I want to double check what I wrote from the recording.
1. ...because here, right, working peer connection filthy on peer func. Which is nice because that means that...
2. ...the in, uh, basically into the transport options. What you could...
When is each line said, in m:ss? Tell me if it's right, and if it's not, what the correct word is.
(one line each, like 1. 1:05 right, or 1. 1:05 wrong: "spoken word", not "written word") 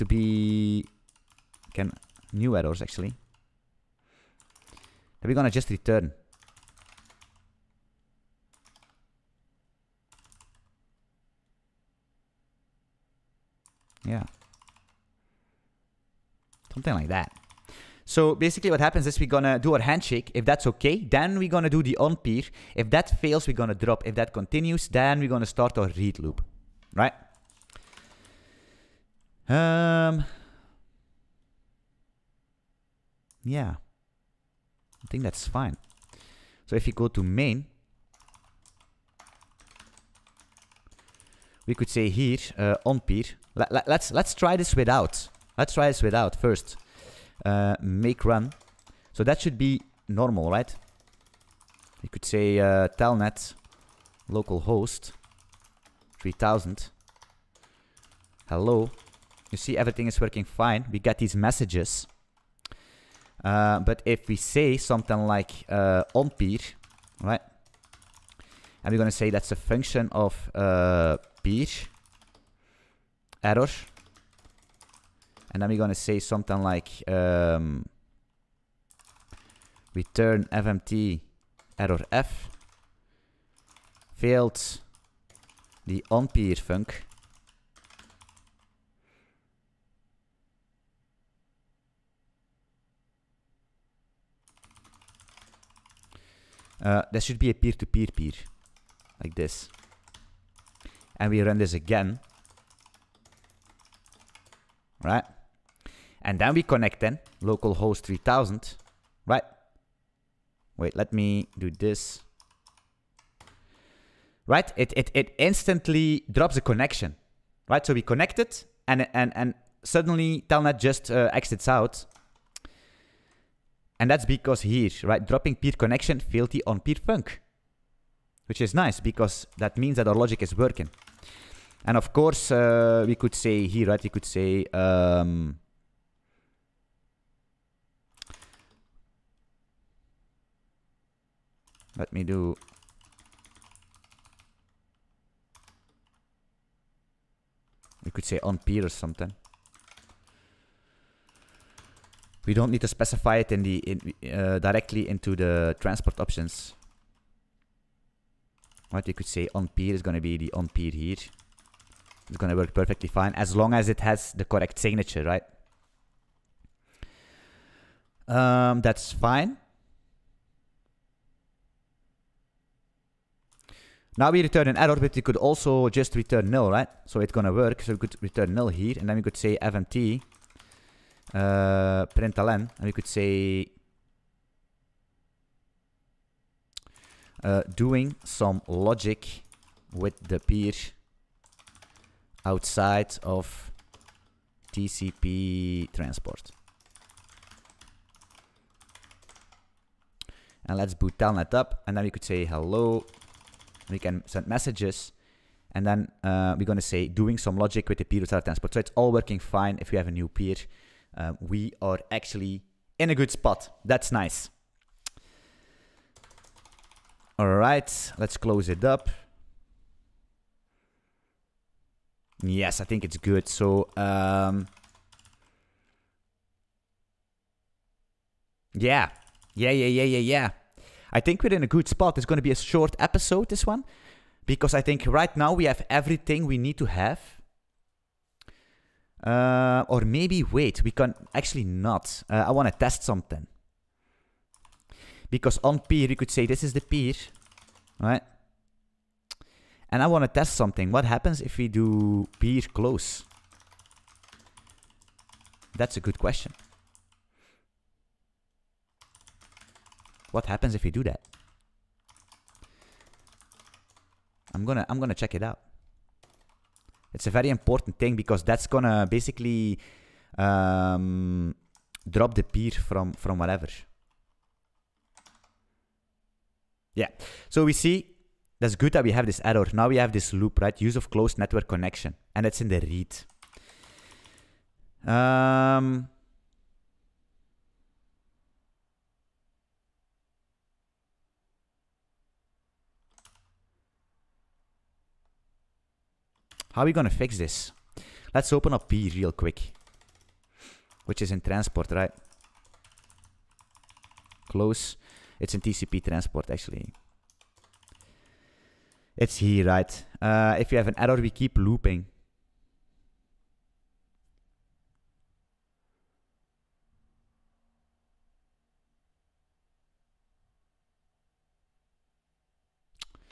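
1. 2:04 wrong: "dropping", not "working"
2. 2:33 wrong: "directly", not "basically".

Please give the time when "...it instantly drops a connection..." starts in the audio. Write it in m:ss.
1:55.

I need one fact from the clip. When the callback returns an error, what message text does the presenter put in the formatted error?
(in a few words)
failed the on peer func.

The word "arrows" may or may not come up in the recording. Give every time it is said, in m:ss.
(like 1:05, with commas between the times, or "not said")
0:02.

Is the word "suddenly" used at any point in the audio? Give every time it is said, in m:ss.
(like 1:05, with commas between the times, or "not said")
1:59.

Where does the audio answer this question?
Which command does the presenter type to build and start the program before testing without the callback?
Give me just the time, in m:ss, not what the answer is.
0:47.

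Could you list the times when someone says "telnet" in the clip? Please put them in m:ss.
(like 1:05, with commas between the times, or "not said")
0:52, 2:00, 3:21.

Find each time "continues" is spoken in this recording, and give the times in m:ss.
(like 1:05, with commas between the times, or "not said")
0:24.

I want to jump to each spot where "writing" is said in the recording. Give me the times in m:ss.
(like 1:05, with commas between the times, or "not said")
not said.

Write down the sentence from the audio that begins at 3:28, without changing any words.
So it's all working fine if we have a new peer uh, we are actually in a good spot.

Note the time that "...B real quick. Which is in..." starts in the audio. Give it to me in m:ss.
4:58.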